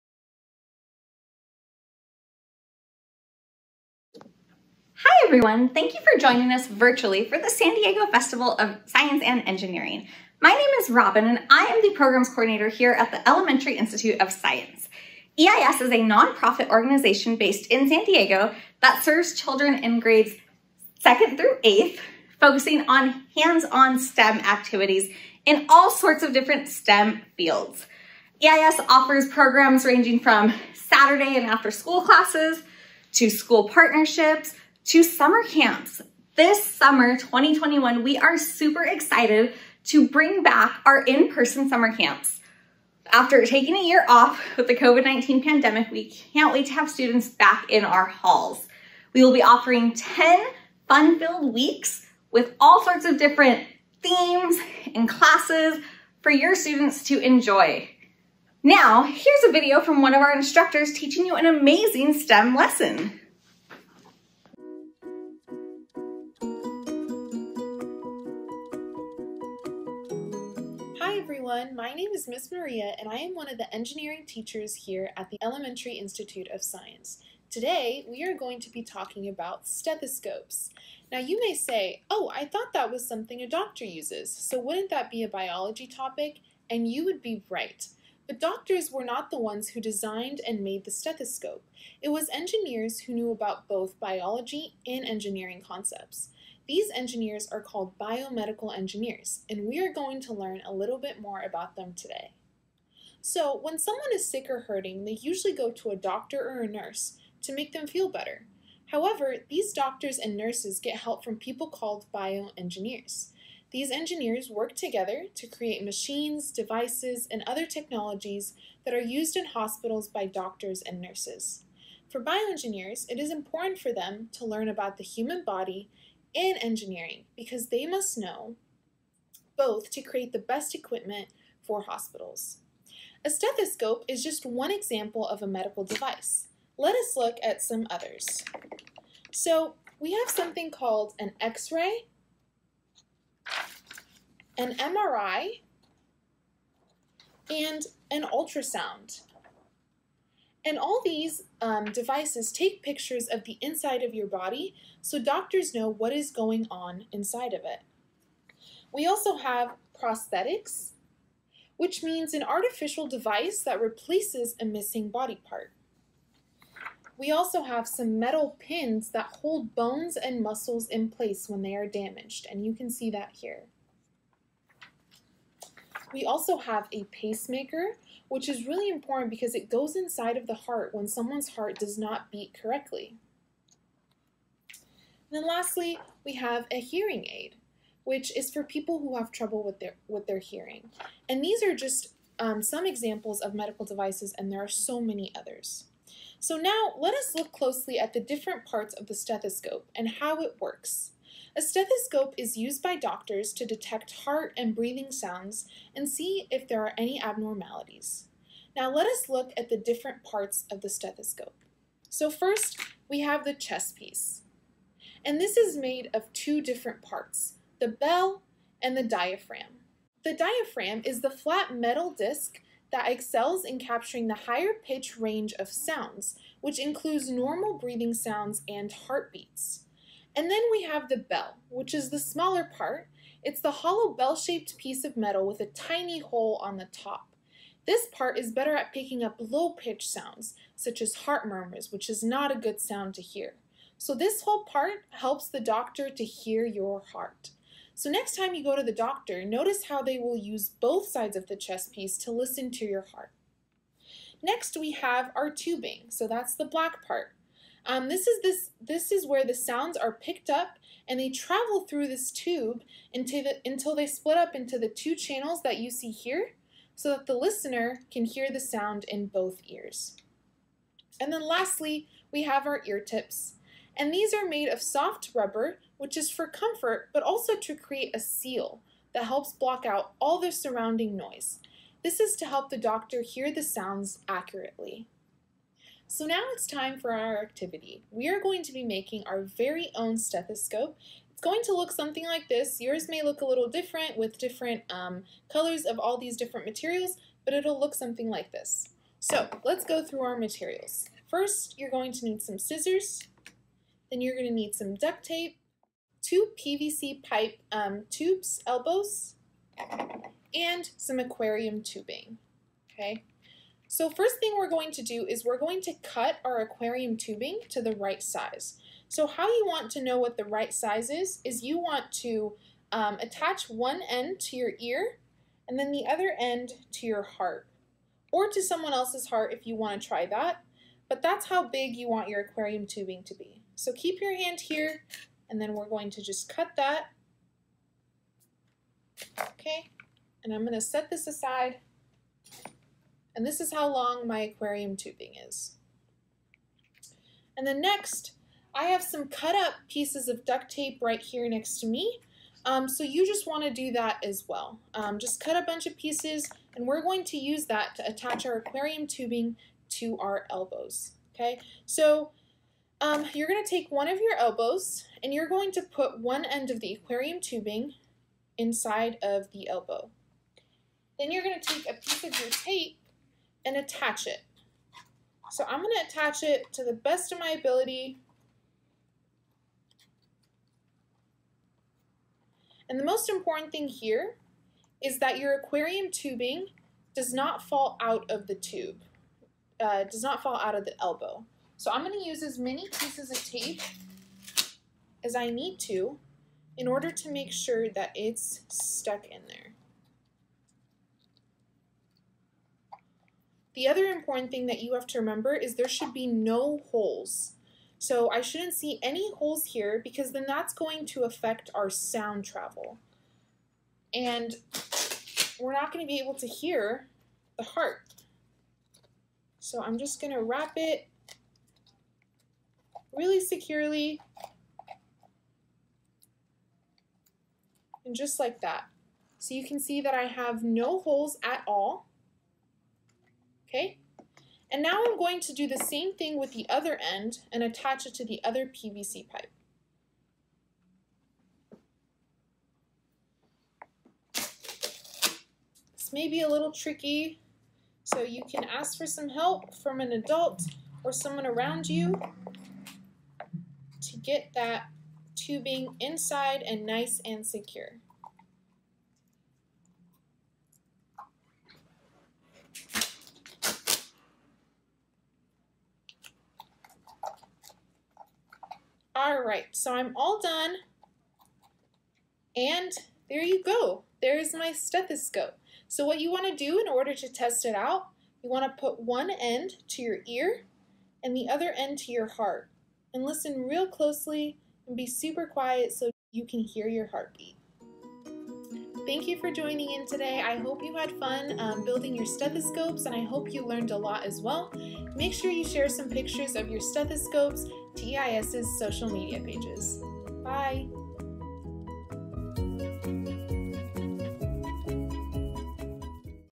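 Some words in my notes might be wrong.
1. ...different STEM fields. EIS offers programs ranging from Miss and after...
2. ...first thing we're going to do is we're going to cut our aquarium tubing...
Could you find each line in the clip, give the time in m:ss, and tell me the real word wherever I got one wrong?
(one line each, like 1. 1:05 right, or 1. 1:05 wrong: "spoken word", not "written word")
1. 0:26 wrong: "Saturday", not "Miss"
2. 5:14 right.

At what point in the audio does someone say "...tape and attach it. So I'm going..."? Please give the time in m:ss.
6:12.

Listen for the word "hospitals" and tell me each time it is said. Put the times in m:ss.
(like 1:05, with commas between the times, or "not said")
1:59, 2:11.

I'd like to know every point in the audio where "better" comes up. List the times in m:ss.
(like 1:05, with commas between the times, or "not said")
1:48, 3:58.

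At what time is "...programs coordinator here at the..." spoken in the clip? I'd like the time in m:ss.
0:11.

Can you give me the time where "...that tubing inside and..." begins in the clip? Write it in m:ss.
7:34.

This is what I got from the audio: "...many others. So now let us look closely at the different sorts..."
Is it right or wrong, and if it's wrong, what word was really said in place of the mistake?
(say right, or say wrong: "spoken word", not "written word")
wrong: "parts", not "sorts".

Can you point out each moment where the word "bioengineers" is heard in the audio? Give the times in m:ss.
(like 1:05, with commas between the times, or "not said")
1:52, 2:02.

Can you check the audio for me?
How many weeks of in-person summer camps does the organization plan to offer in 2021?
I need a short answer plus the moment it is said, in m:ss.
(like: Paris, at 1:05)
10, at 0:49.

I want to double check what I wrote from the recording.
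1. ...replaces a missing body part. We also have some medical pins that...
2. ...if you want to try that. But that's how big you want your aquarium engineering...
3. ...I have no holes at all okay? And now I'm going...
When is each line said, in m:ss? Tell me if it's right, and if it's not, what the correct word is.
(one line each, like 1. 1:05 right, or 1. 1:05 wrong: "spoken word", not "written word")
1. 2:43 wrong: "metal", not "medical"
2. 5:29 wrong: "tubing", not "engineering"
3. 7:10 right.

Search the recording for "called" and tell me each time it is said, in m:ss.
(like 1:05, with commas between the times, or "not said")
1:37, 1:51, 2:20.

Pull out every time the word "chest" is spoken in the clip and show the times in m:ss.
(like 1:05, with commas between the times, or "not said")
3:33, 4:11.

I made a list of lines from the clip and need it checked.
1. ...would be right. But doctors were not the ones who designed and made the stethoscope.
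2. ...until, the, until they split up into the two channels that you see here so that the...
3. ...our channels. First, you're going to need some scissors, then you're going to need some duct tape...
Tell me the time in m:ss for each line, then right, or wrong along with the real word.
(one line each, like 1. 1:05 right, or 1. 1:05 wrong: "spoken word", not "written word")
1. 1:27 right
2. 4:23 right
3. 5:00 wrong: "materials", not "channels".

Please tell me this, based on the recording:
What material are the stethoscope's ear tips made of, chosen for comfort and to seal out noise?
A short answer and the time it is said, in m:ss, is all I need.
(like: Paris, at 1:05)
soft rubber, at 4:34.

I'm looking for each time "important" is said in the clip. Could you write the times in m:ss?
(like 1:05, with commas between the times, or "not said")
2:03, 2:58, 6:23, 6:44.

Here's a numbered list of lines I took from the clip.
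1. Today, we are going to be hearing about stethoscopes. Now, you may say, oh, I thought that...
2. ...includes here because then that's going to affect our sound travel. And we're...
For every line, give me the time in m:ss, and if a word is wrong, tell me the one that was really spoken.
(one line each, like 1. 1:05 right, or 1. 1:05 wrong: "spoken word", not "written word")
1. 1:17 wrong: "talking", not "hearing"
2. 6:49 wrong: "holes", not "includes".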